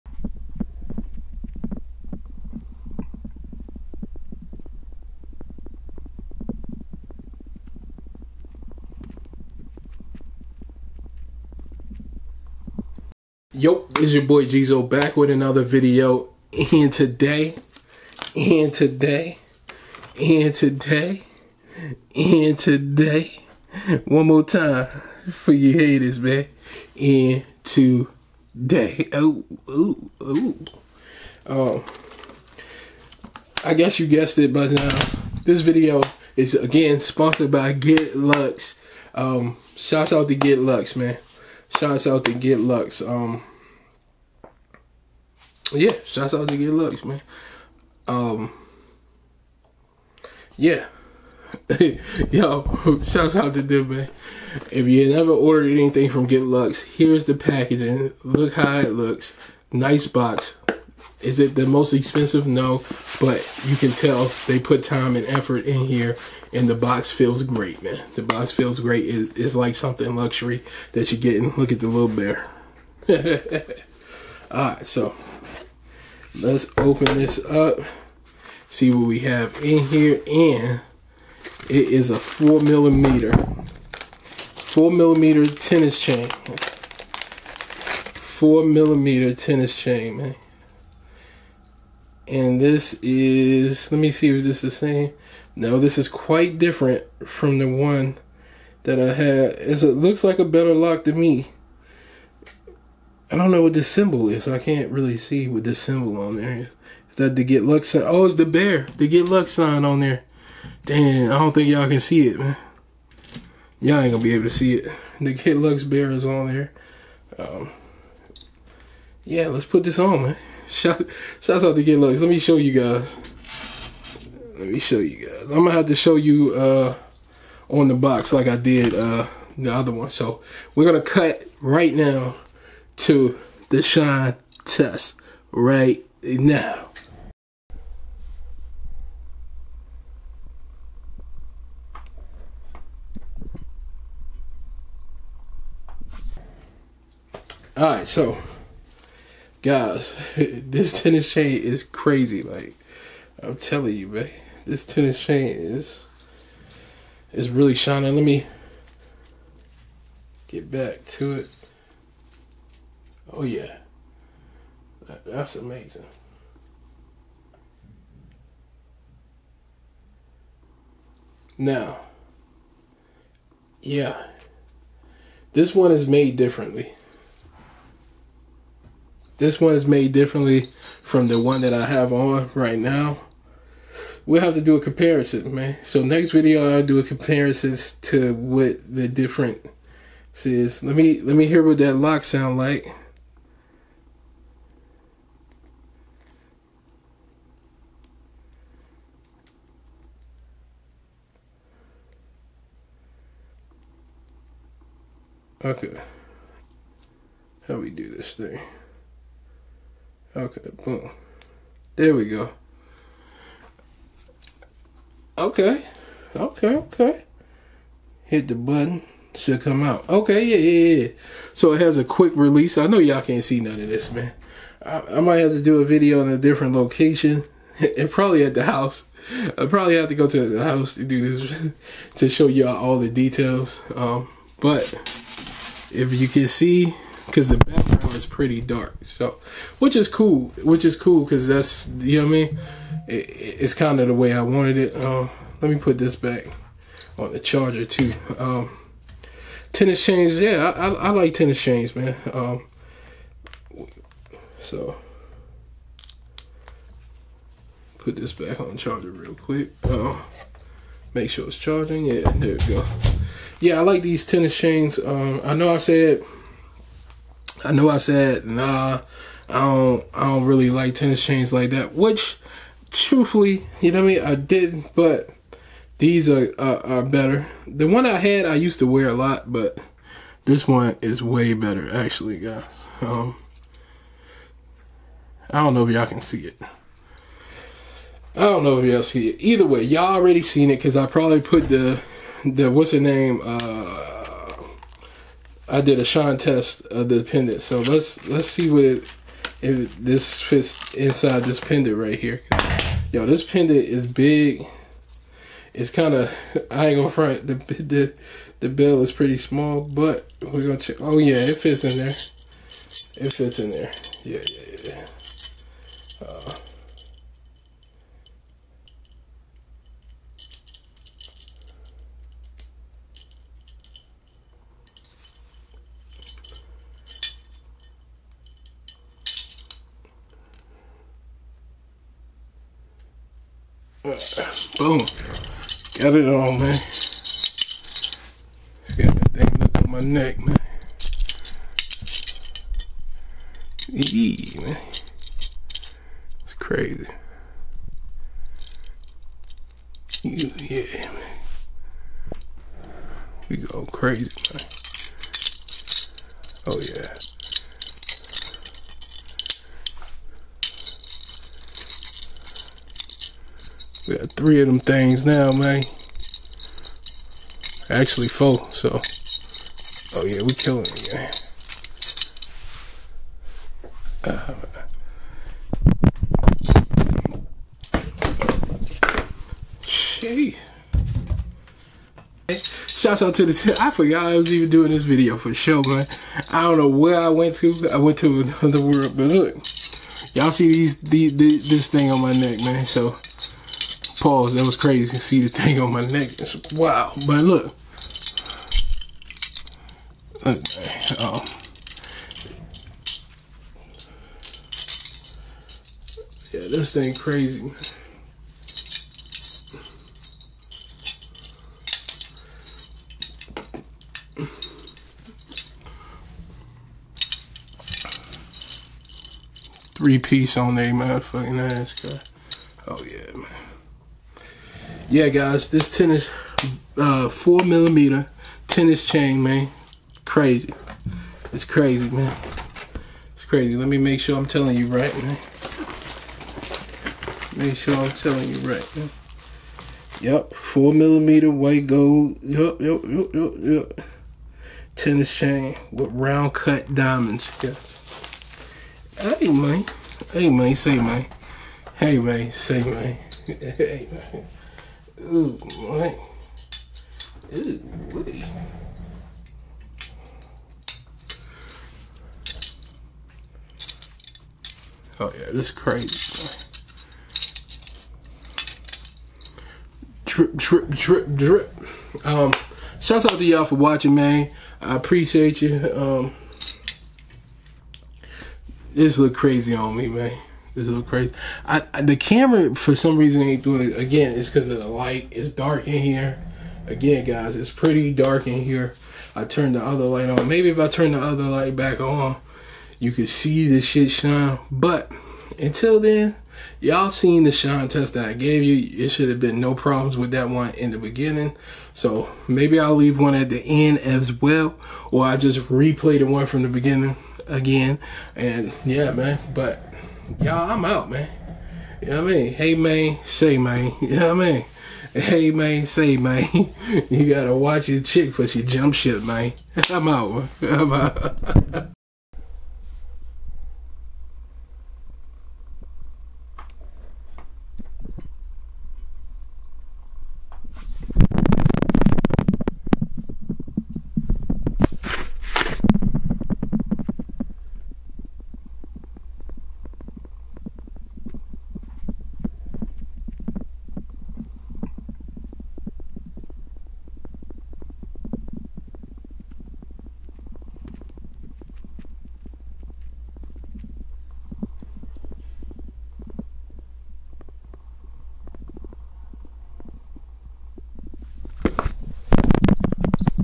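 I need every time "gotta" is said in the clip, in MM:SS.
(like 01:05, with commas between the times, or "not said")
08:37.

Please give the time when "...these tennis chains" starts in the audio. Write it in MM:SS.
04:24.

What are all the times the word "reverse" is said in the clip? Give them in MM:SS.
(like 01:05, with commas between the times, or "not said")
not said.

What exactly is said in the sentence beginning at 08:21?
So maybe I'll leave one at the end as well, or I just replay the one from the beginning again.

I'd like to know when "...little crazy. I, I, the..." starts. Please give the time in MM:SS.
08:00.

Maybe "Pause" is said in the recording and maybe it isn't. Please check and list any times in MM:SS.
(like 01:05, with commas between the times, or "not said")
06:34.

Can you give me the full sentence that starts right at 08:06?
Again, guys, it's pretty dark in here.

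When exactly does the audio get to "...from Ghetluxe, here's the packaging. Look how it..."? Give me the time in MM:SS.
00:56.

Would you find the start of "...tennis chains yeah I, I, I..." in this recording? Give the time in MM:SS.
04:09.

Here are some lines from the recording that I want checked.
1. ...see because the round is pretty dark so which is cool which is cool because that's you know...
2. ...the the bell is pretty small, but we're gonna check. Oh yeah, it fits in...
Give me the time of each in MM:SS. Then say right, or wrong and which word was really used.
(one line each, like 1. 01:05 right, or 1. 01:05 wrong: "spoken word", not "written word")
1. 03:56 wrong: "background", not "round"
2. 05:07 right.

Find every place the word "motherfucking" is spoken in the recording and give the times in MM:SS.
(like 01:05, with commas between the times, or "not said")
07:00.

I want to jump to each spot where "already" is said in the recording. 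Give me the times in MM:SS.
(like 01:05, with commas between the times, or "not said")
04:50.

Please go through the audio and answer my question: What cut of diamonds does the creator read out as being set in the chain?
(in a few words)
round cut.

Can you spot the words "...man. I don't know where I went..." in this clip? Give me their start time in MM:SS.
06:25.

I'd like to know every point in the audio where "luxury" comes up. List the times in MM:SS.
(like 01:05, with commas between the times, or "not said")
01:10.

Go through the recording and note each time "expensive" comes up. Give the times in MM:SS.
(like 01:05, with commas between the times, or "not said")
01:01.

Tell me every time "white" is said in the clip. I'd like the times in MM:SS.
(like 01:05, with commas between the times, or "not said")
07:21.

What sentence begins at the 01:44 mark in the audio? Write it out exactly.
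I can't really see what this symbol on there is.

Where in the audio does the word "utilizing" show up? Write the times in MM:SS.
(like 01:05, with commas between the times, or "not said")
not said.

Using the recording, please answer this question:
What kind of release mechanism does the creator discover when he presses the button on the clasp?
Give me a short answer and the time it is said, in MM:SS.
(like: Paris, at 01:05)
quick release, at 03:42.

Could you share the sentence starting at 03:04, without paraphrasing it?
We'll have to do a comparison, man.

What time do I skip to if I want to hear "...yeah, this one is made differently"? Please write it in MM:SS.
02:53.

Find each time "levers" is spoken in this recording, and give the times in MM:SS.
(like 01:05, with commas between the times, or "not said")
not said.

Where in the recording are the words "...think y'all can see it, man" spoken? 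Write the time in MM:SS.
01:51.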